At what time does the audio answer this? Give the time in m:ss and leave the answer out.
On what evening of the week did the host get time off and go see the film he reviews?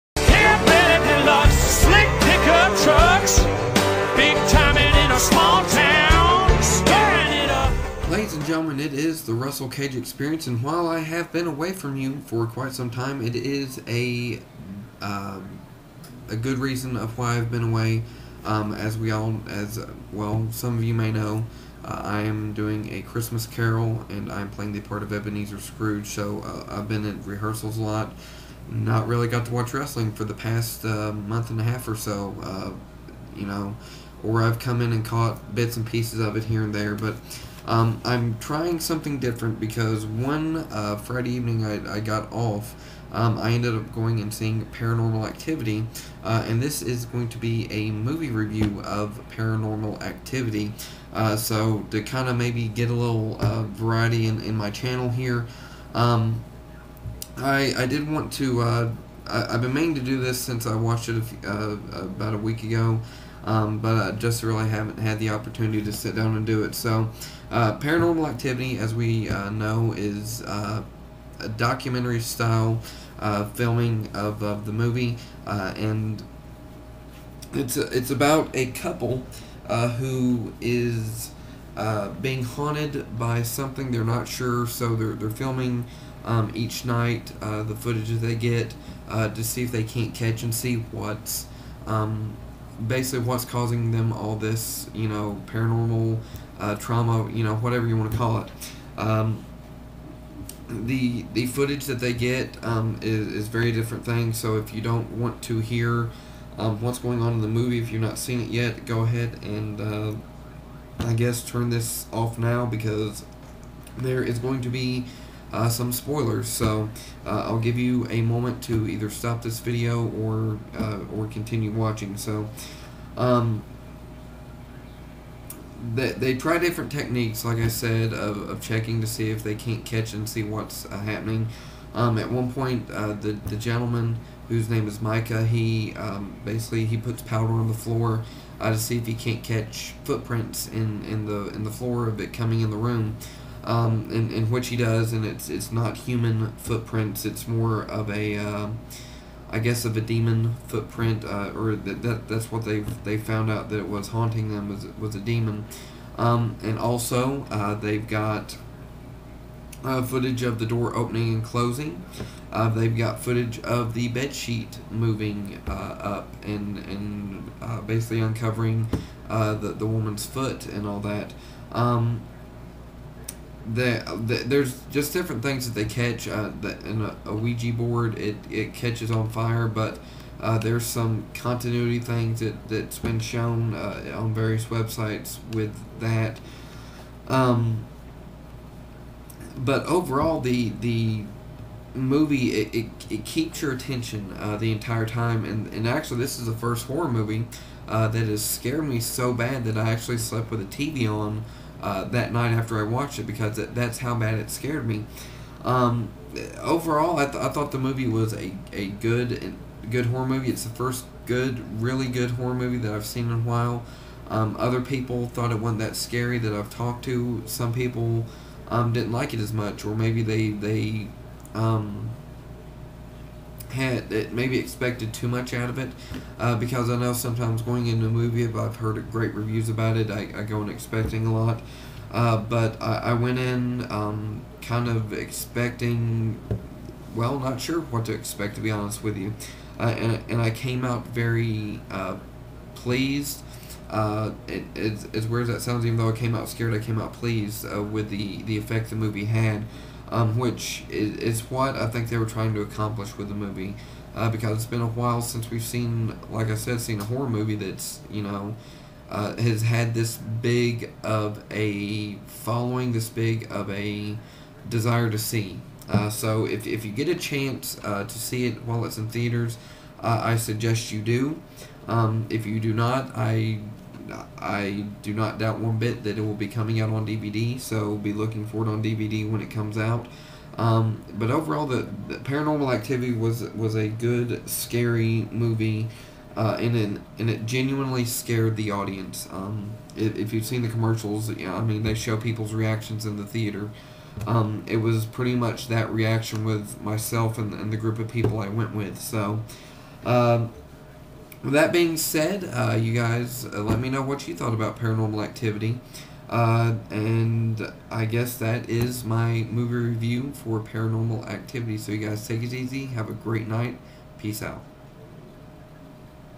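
0:40.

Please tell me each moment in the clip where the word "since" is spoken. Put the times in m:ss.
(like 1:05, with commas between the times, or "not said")
1:00, 4:15.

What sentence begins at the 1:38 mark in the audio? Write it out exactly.
Um, the the footage that they get um, is, is very different thing.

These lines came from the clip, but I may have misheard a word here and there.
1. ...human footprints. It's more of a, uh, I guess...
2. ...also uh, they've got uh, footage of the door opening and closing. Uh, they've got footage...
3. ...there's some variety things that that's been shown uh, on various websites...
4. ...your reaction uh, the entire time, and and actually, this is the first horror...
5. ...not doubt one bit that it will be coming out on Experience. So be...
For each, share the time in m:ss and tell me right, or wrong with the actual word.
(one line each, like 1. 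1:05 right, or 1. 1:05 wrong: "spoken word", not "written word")
1. 2:25 right
2. 2:36 right
3. 3:00 wrong: "continuity", not "variety"
4. 3:13 wrong: "attention", not "reaction"
5. 4:35 wrong: "DVD", not "Experience".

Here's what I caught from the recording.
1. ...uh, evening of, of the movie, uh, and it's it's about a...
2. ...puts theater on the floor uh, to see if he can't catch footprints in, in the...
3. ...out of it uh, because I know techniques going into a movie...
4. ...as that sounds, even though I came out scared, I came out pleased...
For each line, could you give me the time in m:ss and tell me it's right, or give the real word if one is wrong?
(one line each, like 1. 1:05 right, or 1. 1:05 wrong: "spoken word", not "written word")
1. 1:13 wrong: "filming", not "evening"
2. 2:16 wrong: "powder", not "theater"
3. 3:45 wrong: "sometimes", not "techniques"
4. 4:05 right.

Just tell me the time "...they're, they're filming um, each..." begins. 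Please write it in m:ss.
1:24.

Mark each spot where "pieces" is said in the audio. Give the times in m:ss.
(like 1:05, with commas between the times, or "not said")
0:35.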